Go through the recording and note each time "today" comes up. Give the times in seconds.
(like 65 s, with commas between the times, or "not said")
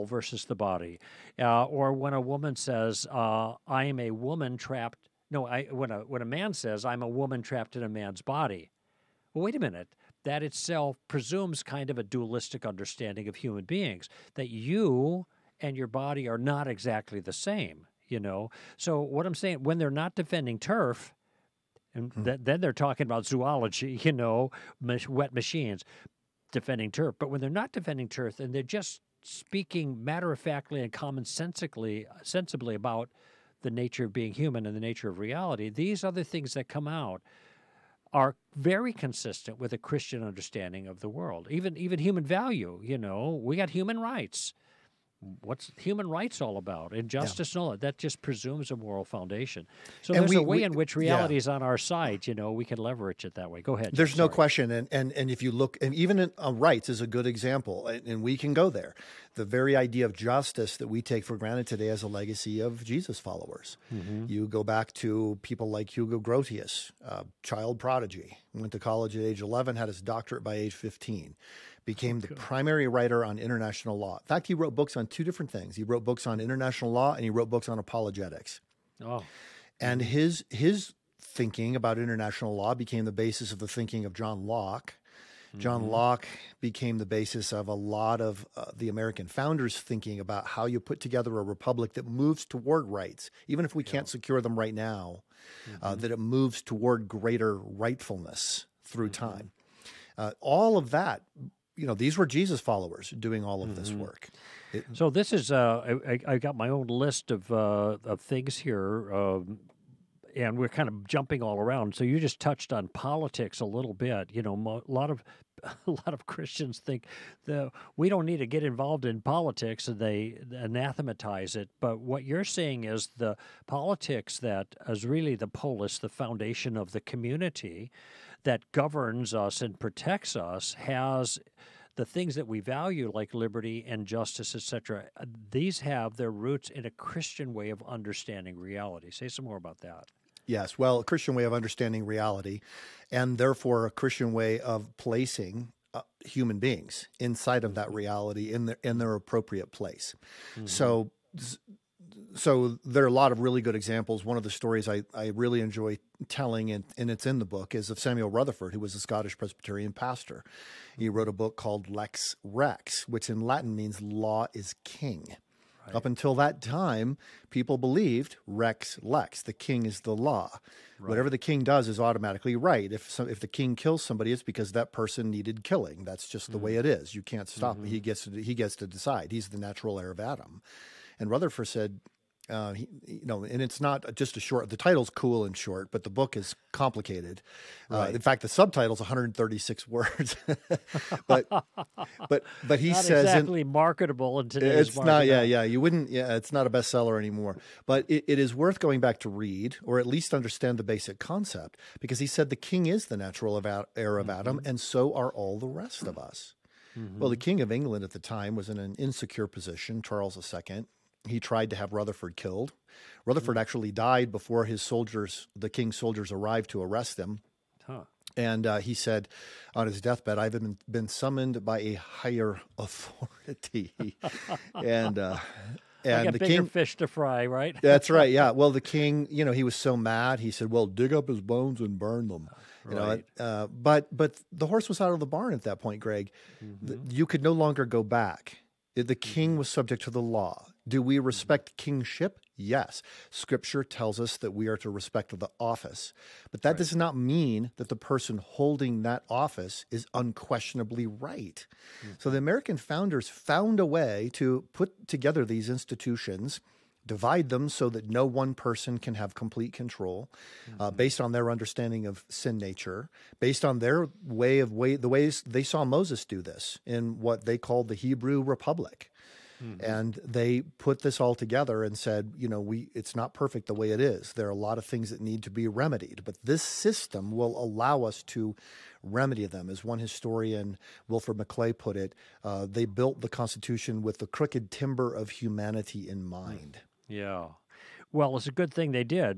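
61 s, 194 s.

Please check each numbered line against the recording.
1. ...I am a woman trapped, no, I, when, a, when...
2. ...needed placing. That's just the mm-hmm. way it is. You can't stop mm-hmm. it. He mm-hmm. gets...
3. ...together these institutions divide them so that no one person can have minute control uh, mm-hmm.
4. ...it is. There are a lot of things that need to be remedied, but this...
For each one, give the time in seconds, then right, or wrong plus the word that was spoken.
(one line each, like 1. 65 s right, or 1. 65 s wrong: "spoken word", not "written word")
1. 3 s right
2. 175 s wrong: "killing", not "placing"
3. 255 s wrong: "complete", not "minute"
4. 273 s right.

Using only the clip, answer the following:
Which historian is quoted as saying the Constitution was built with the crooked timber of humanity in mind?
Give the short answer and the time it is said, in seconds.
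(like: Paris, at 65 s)
Wilfred McClay, at 281 s.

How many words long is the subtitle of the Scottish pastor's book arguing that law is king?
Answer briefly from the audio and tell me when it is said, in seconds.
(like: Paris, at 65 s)
136, at 188 s.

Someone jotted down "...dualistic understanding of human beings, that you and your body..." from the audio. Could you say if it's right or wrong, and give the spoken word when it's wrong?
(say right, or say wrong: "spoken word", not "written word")
right.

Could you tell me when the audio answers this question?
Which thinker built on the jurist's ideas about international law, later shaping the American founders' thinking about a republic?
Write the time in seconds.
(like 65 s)
84 s.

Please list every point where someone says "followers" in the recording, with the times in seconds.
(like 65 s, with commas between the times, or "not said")
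63 s, 102 s.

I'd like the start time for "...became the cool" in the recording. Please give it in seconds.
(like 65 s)
71 s.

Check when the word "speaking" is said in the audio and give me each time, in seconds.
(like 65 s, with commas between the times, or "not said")
29 s.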